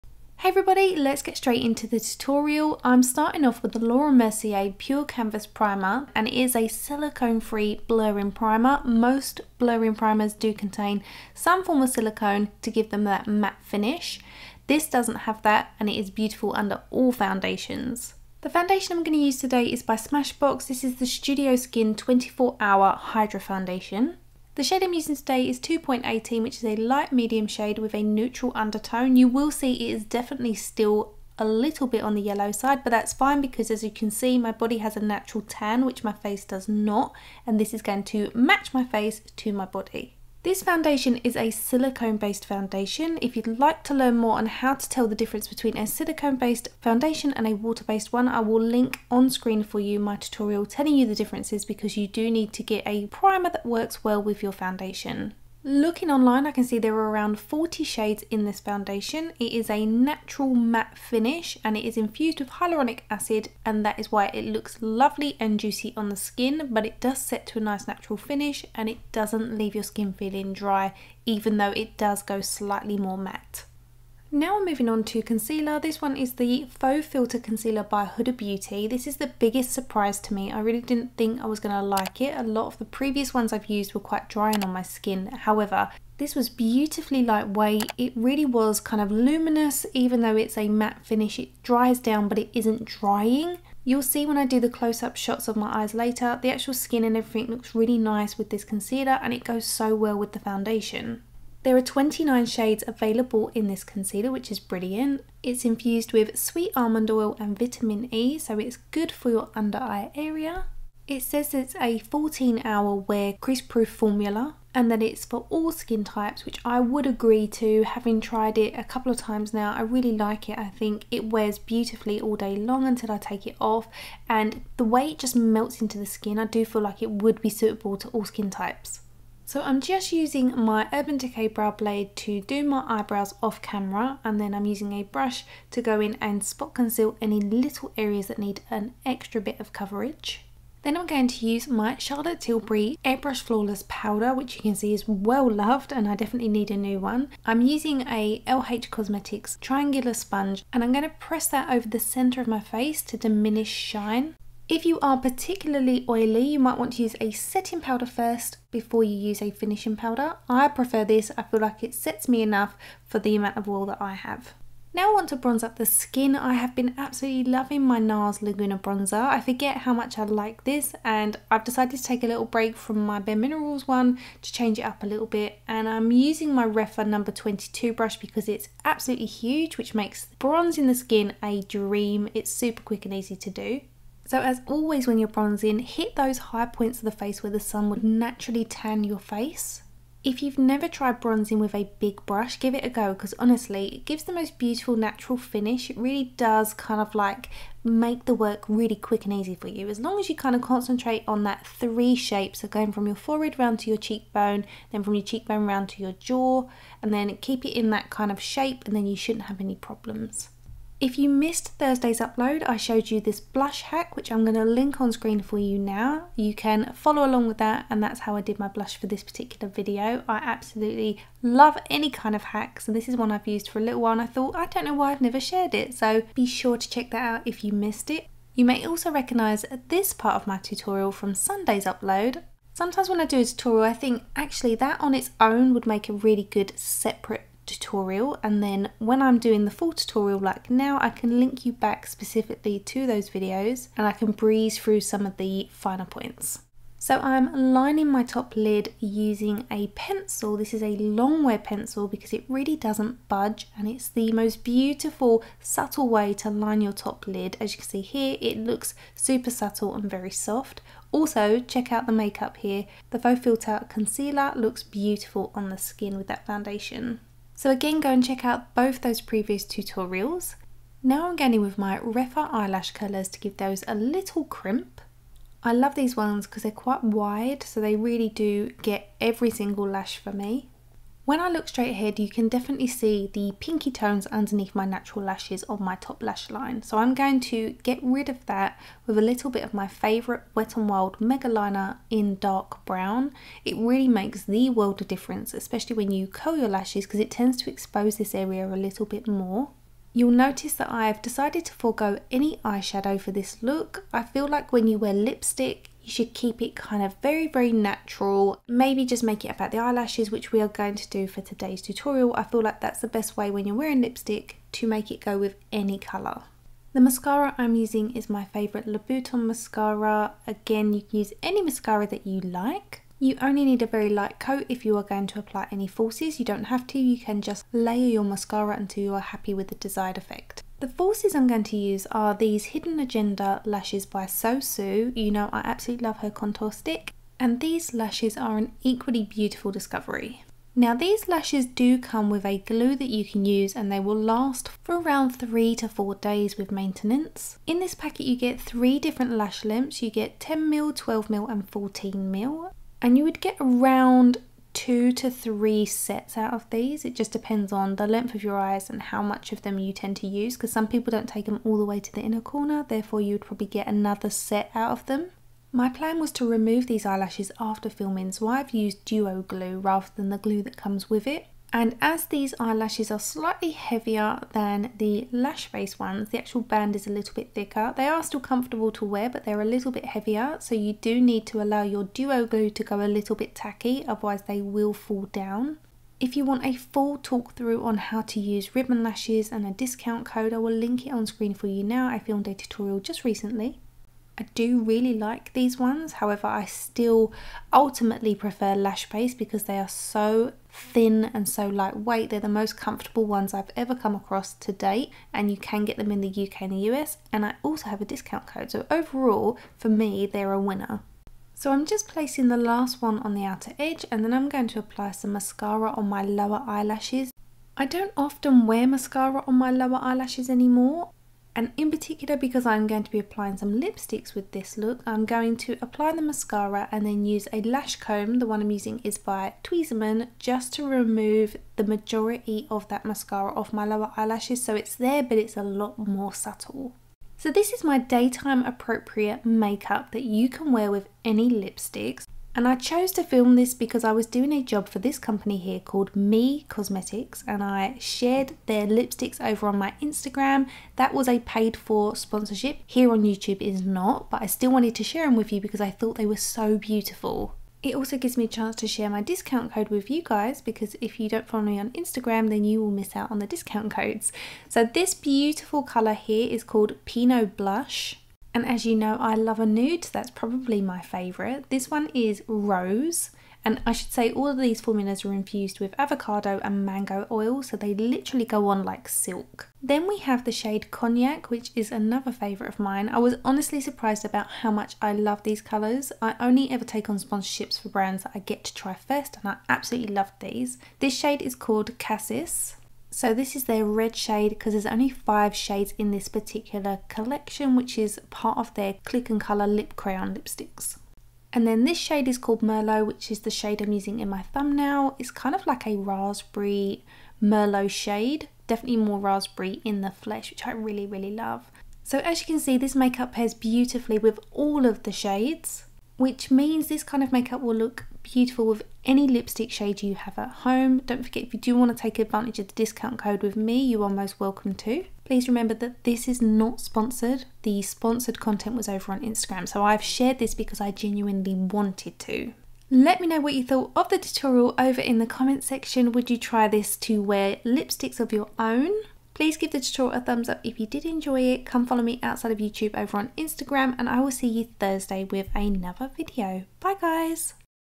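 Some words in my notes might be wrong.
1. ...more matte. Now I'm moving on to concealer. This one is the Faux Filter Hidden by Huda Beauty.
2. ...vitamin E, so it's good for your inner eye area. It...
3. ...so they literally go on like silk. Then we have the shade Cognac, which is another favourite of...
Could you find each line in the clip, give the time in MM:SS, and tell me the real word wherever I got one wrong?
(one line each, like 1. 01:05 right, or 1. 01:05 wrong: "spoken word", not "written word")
1. 01:12 wrong: "Concealer", not "Hidden"
2. 01:47 wrong: "under", not "inner"
3. 07:57 right.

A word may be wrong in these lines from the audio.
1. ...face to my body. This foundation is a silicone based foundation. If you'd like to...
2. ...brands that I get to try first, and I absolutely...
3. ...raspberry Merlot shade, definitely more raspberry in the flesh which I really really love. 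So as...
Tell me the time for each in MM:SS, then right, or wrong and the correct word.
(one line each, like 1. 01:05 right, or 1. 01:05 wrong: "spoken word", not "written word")
1. 00:38 right
2. 08:07 right
3. 08:25 right.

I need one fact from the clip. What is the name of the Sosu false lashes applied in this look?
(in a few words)
Hidden Agenda.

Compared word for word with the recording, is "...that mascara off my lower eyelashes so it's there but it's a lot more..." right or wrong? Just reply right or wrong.
right.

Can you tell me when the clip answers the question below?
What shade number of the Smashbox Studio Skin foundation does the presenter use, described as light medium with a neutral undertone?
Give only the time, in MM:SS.
00:25.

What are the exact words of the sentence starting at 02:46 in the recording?
I have been absolutely loving my NARS Laguna Bronzer.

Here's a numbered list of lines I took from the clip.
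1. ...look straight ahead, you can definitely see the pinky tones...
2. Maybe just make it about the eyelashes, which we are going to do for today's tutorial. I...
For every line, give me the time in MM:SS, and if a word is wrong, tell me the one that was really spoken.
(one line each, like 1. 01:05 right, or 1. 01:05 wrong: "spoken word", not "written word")
1. 04:41 right
2. 05:08 right.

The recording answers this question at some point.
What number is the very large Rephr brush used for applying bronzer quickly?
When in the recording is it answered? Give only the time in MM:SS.
02:57.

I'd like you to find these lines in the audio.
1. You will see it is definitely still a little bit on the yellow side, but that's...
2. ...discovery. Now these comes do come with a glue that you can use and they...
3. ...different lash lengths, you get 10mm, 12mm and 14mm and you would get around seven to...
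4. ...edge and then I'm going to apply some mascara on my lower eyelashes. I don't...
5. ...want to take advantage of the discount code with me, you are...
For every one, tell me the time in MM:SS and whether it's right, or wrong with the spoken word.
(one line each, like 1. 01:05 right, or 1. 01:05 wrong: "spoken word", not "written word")
1. 00:29 right
2. 05:39 wrong: "lashes", not "comes"
3. 05:48 wrong: "two", not "seven"
4. 06:53 right
5. 08:41 right.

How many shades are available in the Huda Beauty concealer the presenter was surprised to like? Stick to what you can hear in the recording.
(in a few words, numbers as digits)
29.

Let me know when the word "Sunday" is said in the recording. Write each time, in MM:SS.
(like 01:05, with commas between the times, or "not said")
03:51.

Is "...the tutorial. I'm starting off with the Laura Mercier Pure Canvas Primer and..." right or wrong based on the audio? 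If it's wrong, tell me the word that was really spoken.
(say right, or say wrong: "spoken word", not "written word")
right.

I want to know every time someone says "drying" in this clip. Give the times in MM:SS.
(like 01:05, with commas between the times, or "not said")
01:24, 01:32.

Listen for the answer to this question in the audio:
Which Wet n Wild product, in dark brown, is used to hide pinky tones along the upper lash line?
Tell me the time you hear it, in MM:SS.
04:51.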